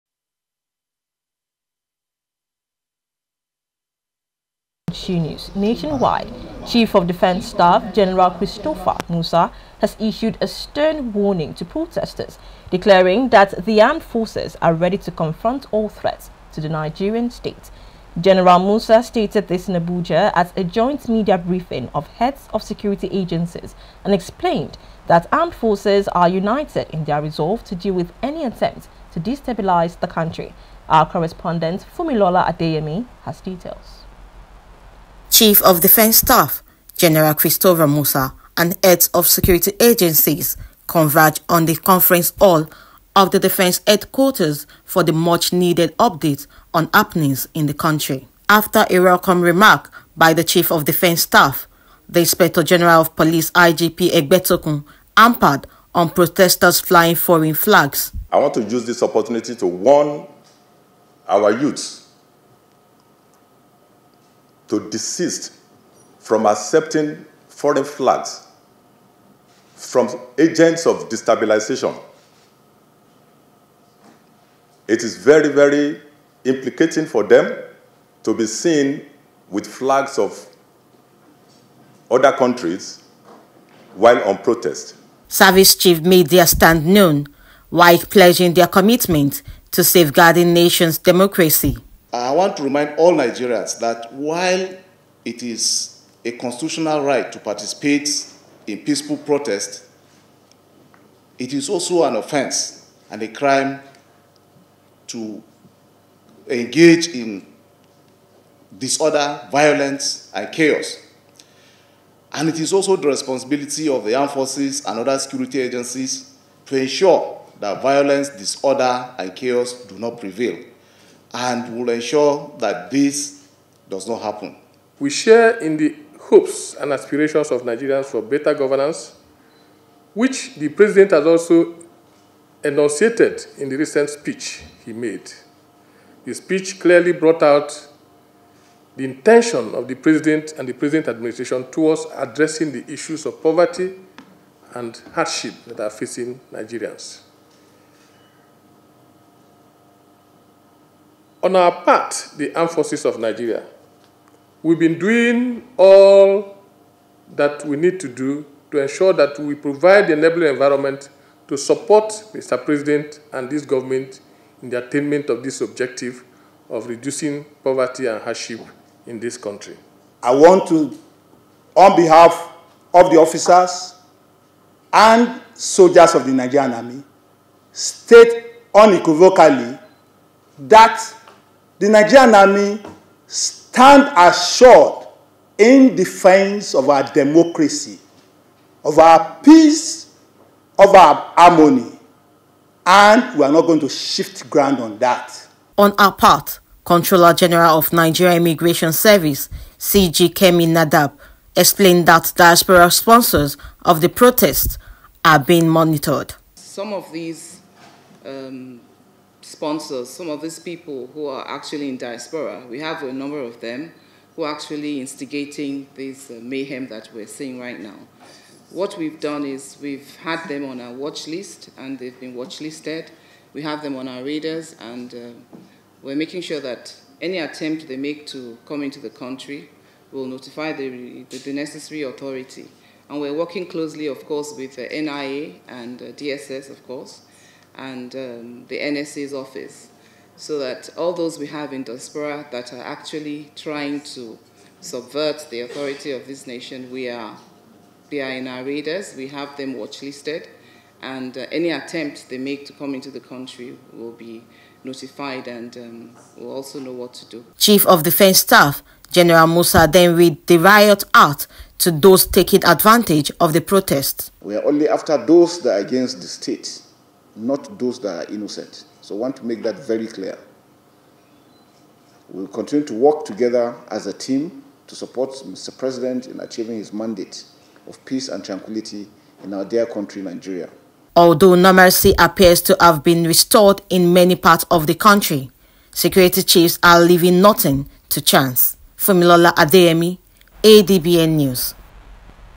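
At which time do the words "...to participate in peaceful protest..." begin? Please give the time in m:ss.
1:37.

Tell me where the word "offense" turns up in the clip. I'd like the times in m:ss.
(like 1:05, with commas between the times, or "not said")
1:42.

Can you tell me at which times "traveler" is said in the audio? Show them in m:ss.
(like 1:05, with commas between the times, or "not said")
not said.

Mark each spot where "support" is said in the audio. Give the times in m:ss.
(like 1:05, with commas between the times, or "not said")
2:41, 4:34.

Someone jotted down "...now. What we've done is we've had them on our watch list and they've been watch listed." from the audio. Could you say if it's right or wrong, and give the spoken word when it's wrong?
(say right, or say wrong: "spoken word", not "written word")
right.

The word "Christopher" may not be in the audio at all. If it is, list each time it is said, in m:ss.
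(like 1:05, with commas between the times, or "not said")
0:08, 0:37.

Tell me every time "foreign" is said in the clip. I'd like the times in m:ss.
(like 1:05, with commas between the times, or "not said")
0:57, 1:07.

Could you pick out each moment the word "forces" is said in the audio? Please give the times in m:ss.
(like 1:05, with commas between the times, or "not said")
0:14, 0:25, 1:54, 2:32.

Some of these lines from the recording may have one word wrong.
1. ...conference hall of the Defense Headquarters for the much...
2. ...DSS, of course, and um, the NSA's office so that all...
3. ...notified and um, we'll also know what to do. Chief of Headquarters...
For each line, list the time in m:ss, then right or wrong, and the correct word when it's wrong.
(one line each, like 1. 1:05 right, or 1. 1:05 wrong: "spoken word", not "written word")
1. 0:41 right
2. 3:56 right
3. 4:14 wrong: "Defense", not "Headquarters".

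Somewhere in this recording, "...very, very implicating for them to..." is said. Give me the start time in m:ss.
1:15.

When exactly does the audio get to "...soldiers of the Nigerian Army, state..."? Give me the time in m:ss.
2:55.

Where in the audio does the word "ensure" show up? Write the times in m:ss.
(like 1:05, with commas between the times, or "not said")
1:56, 2:01, 2:38.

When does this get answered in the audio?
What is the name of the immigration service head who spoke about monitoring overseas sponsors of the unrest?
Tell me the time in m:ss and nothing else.
3:20.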